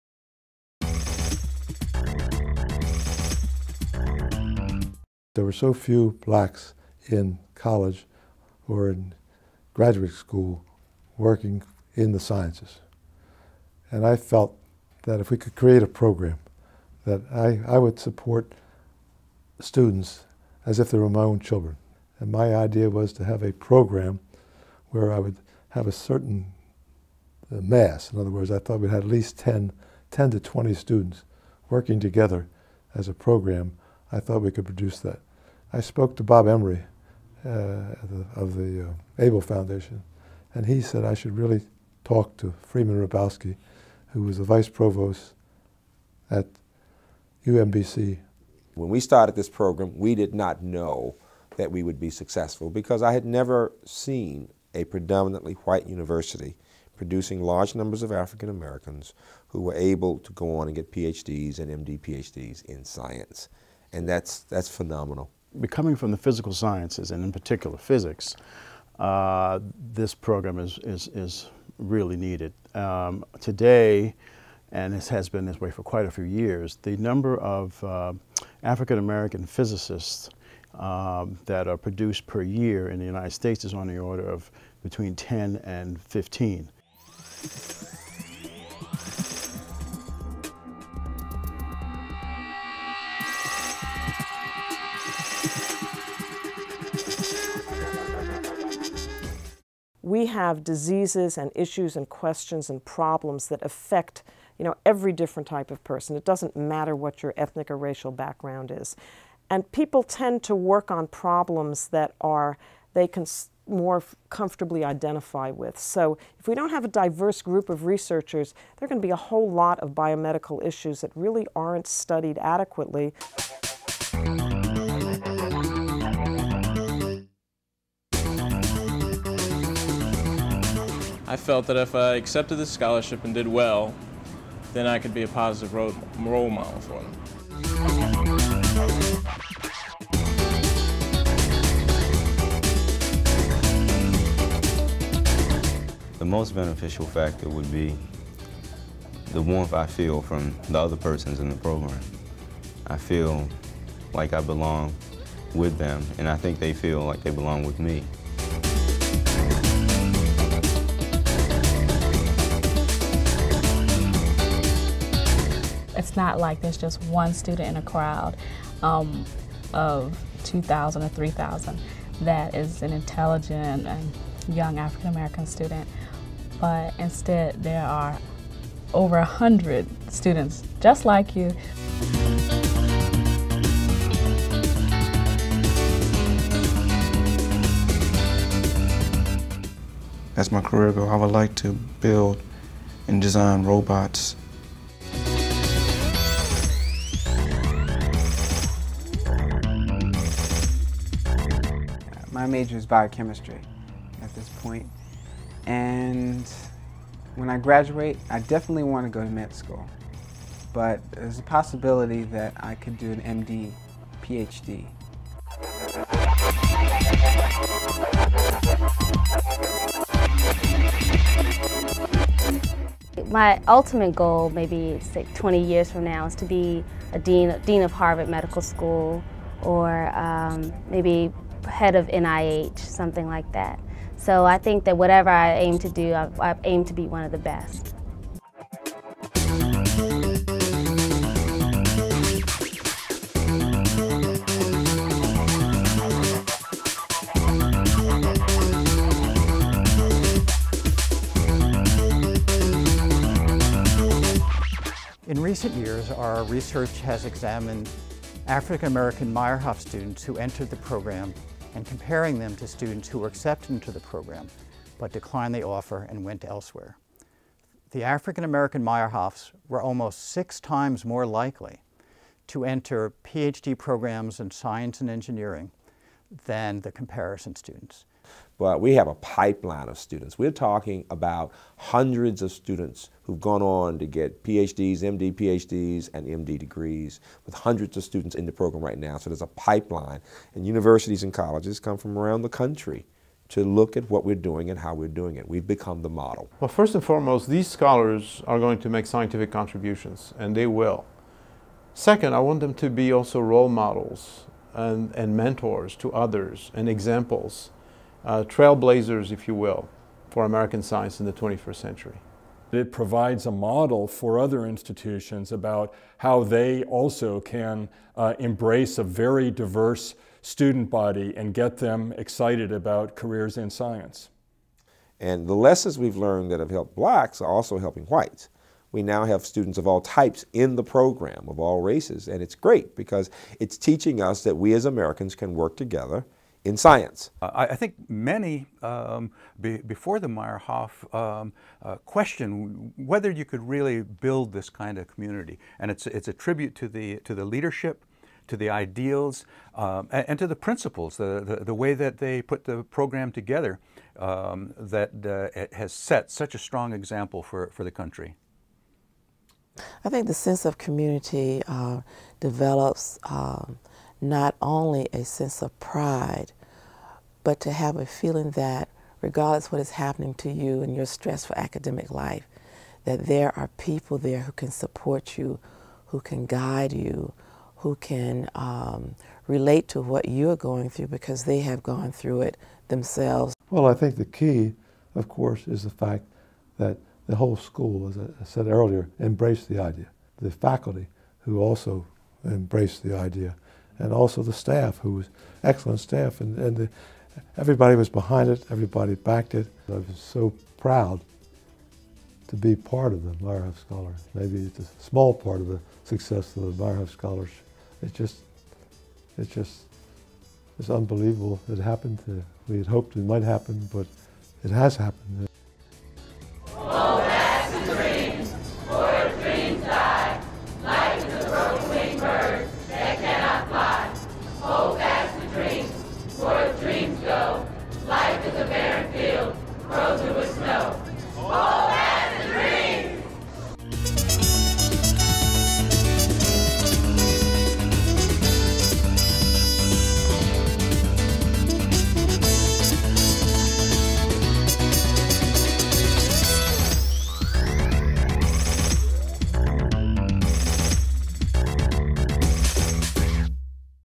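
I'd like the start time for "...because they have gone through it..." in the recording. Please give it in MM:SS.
06:21.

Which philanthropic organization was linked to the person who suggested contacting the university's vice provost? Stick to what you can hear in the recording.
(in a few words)
Abell Foundation.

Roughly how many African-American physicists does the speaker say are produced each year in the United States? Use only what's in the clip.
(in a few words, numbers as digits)
10 to 15.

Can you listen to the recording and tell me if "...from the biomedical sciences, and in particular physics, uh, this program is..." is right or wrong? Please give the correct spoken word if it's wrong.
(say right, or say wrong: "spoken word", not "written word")
wrong: "physical", not "biomedical".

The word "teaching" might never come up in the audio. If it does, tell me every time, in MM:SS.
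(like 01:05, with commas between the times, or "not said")
05:33.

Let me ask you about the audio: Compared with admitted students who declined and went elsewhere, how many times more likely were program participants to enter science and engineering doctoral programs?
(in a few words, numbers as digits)
6 times.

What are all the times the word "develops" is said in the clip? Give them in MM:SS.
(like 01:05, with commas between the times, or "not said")
06:02.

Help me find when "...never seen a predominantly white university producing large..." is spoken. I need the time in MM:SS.
00:53.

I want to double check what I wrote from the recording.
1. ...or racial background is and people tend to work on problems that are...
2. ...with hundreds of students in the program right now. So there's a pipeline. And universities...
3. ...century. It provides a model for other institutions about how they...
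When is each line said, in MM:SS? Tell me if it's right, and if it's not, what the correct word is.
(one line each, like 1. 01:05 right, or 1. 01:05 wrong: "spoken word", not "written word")
1. 01:47 right
2. 04:47 right
3. 05:11 right.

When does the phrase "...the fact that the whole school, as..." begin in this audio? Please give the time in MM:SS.
06:25.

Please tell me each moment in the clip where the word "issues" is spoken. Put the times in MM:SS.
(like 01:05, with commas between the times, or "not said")
01:41, 02:00.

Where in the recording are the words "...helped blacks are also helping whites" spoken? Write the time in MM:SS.
05:26.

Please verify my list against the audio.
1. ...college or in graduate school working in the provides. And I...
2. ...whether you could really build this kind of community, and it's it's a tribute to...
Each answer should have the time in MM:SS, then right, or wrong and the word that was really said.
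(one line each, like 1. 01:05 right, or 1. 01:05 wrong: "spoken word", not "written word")
1. 00:07 wrong: "sciences", not "provides"
2. 05:42 right.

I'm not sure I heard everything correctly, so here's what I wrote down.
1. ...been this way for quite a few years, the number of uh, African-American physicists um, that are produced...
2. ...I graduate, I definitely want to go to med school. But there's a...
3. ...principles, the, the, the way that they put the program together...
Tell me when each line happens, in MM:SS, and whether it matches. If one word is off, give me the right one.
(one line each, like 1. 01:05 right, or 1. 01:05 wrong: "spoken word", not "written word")
1. 01:15 right
2. 03:27 right
3. 05:50 right.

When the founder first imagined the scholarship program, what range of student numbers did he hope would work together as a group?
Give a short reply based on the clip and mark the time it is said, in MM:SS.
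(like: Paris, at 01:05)
10 to 20, at 00:30.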